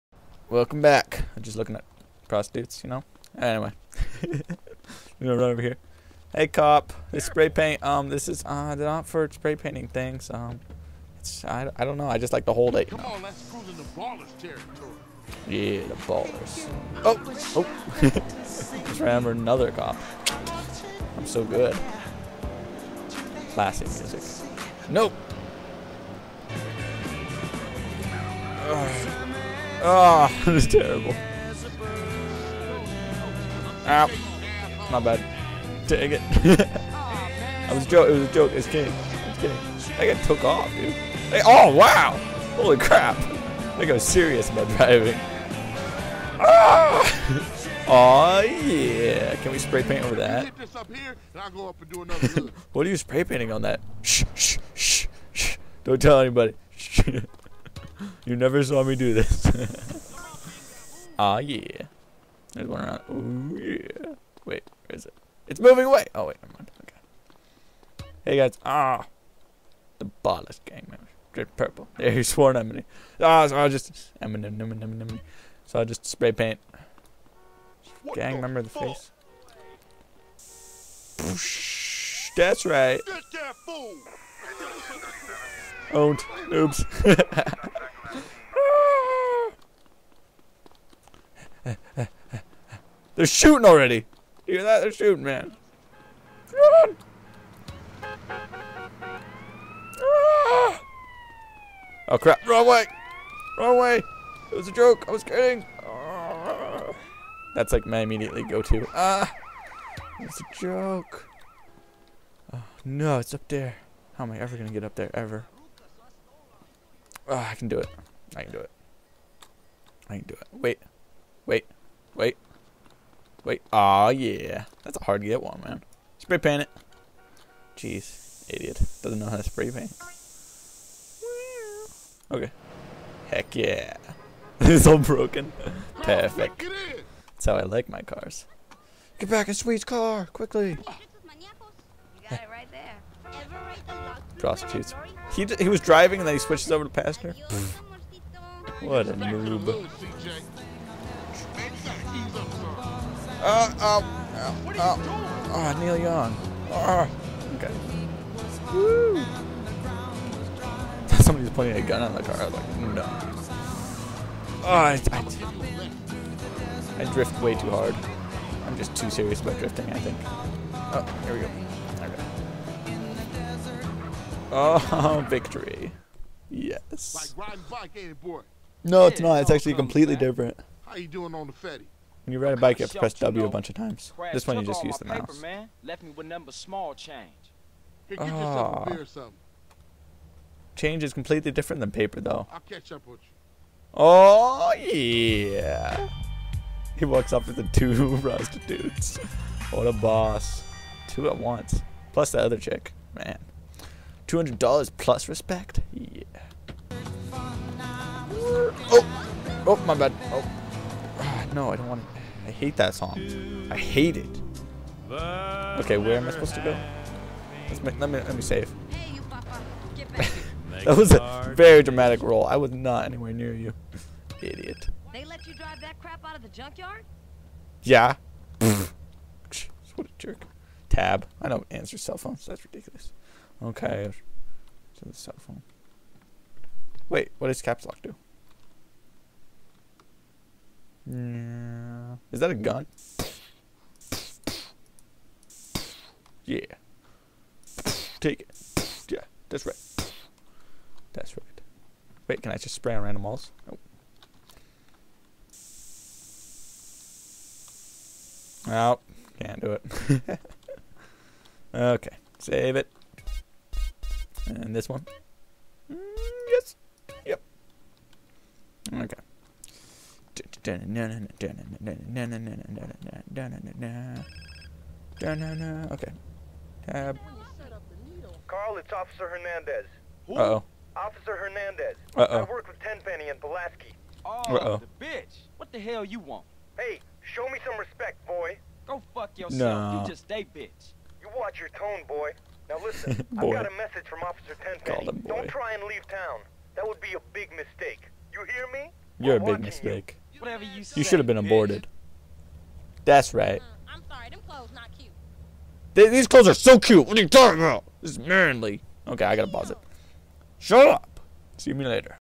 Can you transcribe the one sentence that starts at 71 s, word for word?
There, he swore an Ah, so I just.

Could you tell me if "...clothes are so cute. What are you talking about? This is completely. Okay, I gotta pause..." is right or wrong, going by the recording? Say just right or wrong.
wrong.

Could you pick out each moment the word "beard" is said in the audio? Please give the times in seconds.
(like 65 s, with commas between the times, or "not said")
not said.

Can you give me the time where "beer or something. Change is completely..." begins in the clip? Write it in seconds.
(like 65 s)
188 s.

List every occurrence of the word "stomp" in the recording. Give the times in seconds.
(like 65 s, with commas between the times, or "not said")
not said.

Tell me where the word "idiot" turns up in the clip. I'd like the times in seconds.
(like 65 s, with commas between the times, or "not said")
128 s, 224 s.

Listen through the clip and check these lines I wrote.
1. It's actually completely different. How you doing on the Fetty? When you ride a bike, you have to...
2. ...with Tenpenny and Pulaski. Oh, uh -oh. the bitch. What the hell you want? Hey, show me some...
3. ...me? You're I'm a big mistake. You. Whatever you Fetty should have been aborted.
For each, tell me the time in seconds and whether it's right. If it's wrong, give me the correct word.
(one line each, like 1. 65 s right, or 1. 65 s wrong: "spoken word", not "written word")
1. 179 s right
2. 282 s right
3. 298 s wrong: "You", not "Fetty".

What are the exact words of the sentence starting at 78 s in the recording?
What gang member in the face.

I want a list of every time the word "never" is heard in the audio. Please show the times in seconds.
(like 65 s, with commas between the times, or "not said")
58 s, 66 s.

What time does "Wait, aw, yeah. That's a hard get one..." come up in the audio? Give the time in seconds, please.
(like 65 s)
123 s.